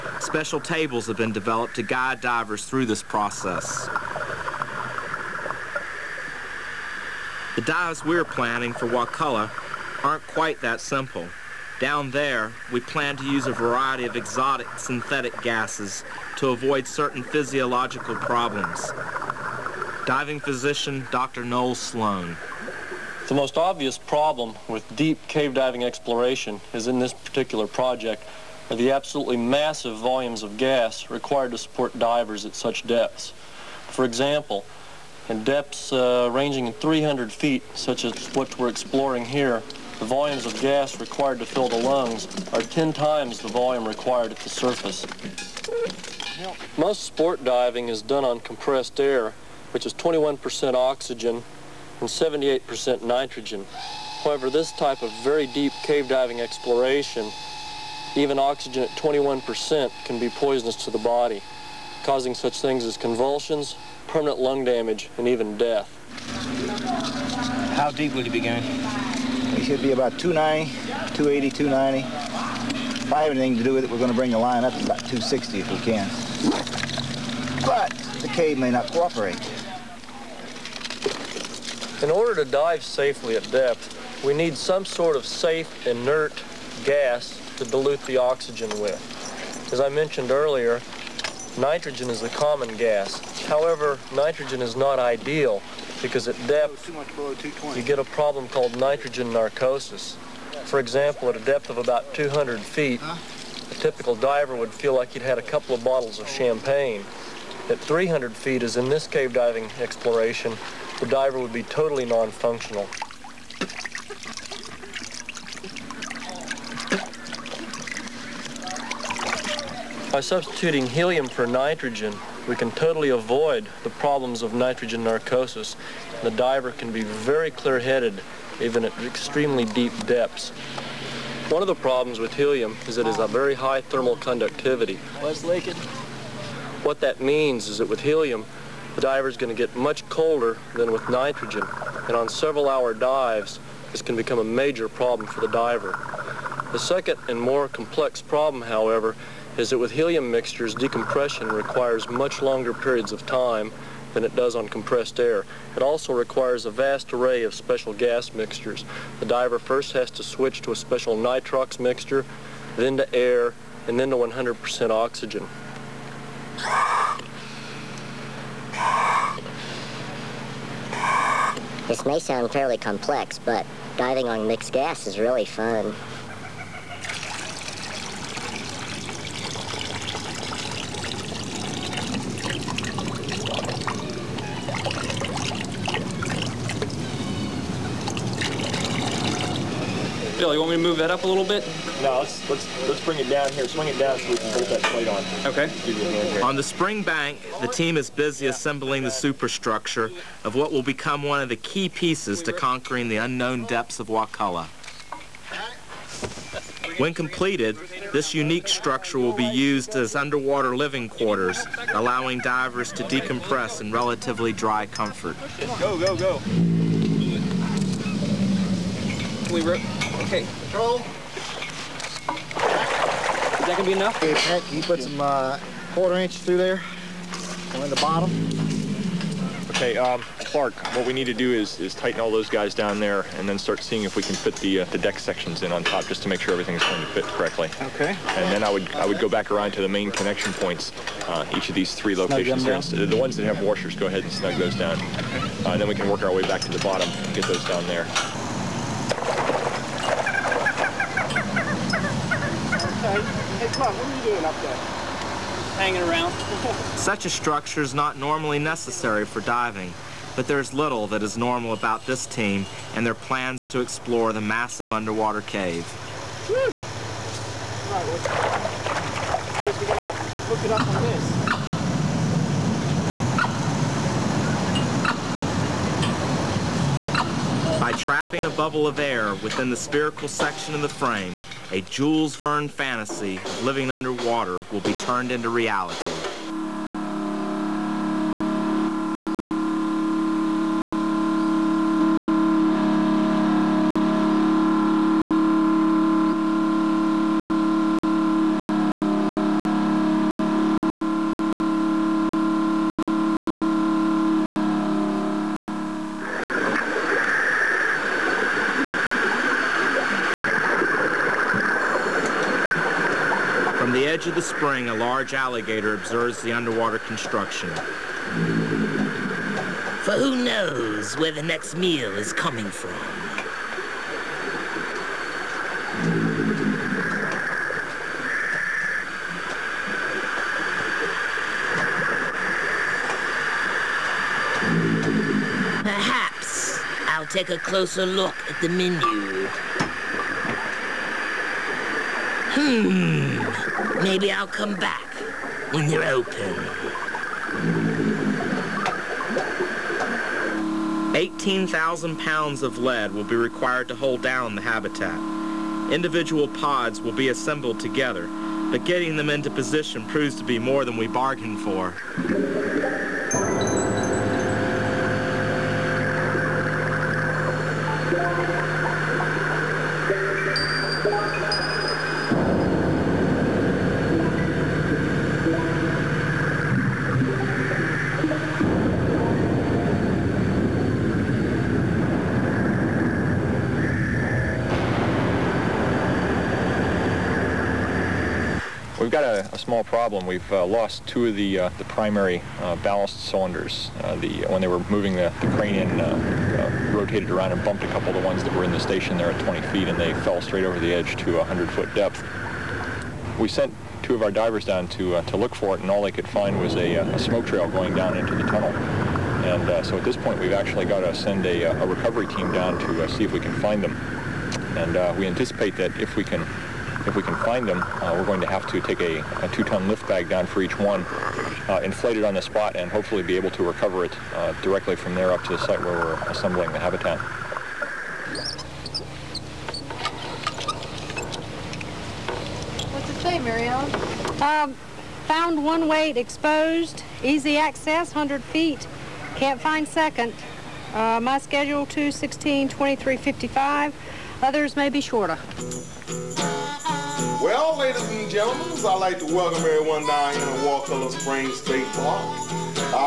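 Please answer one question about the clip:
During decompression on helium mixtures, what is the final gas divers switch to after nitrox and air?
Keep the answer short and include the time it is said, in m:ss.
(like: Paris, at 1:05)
100% oxygen, at 2:44.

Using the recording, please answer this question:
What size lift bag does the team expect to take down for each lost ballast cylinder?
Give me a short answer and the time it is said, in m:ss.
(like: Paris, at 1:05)
Two-ton, at 6:59.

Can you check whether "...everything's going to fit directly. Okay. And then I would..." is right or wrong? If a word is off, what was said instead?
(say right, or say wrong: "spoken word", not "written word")
wrong: "correctly", not "directly".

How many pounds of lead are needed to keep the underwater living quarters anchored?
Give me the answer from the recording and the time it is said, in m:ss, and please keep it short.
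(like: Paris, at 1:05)
18,000, at 5:51.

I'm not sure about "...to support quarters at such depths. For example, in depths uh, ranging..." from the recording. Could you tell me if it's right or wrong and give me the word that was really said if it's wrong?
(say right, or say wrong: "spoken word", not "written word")
wrong: "divers", not "quarters".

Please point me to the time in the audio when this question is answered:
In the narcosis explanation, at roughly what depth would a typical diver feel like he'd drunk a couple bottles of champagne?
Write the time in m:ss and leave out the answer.
1:42.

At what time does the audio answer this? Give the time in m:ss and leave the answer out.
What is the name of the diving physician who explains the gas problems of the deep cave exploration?
0:21.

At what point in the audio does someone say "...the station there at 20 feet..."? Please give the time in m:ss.
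6:38.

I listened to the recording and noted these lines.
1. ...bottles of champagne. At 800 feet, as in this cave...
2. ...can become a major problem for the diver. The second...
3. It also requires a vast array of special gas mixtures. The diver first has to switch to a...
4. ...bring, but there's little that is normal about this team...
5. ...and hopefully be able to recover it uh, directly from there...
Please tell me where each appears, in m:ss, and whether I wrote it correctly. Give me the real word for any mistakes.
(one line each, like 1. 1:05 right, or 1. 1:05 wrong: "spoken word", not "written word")
1. 1:45 wrong: "300", not "800"
2. 2:24 right
3. 2:35 right
4. 4:19 wrong: "diving", not "bring"
5. 7:02 right.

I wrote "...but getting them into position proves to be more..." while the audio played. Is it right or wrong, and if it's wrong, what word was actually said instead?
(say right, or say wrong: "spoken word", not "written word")
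right.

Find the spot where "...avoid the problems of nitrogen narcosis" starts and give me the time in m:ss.
2:03.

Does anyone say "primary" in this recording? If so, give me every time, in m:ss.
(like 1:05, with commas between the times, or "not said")
6:31.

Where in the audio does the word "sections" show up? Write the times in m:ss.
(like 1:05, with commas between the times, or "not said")
3:55, 4:40.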